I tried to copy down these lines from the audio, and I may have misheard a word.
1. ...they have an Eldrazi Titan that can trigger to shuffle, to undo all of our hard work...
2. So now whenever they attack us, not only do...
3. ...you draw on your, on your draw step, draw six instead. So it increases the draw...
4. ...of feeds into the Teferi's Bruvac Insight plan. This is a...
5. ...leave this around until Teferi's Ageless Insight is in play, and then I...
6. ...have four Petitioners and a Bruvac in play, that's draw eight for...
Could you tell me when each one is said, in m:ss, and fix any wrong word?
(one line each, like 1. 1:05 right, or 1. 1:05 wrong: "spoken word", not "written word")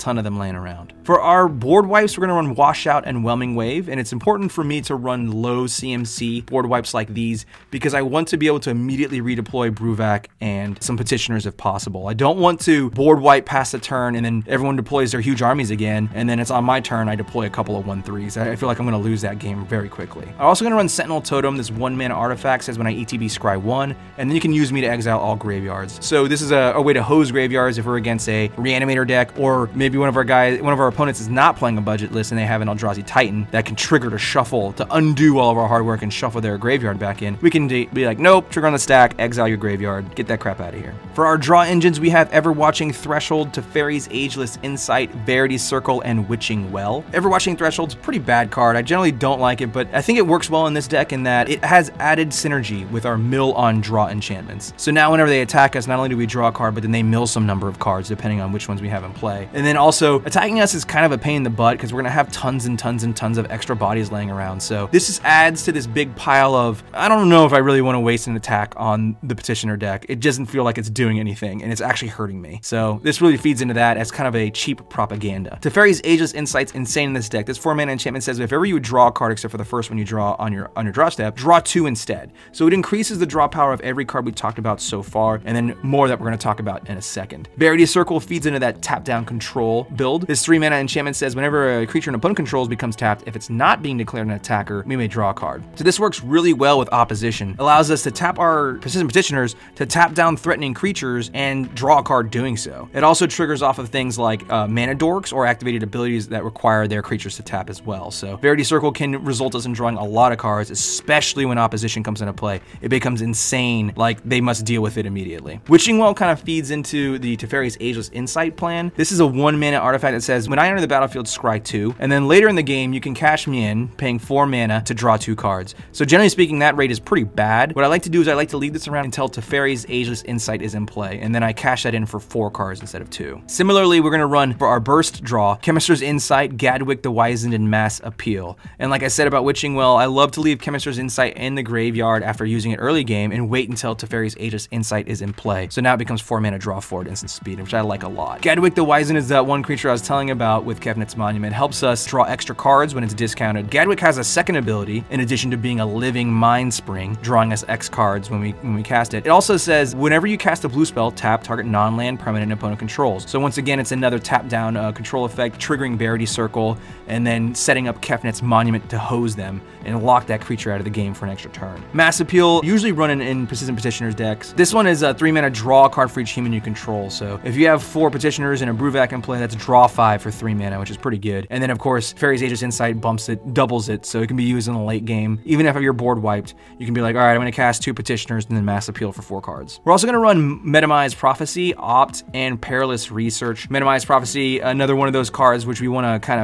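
1. 0:32 right
2. 0:54 right
3. 1:19 wrong: "two", not "six"
4. 1:56 wrong: "Ageless", not "Bruvac"
5. 2:08 right
6. 2:57 wrong: "five", not "eight".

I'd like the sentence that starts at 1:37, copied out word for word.
Allows us to tap our persistent petitioners to tap down threatening creatures and draw a card doing so.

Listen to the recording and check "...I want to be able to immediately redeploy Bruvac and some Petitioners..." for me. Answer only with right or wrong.
right.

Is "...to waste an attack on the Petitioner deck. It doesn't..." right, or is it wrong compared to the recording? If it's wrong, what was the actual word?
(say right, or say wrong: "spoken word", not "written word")
right.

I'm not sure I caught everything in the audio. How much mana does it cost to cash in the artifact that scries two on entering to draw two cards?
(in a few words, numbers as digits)
4.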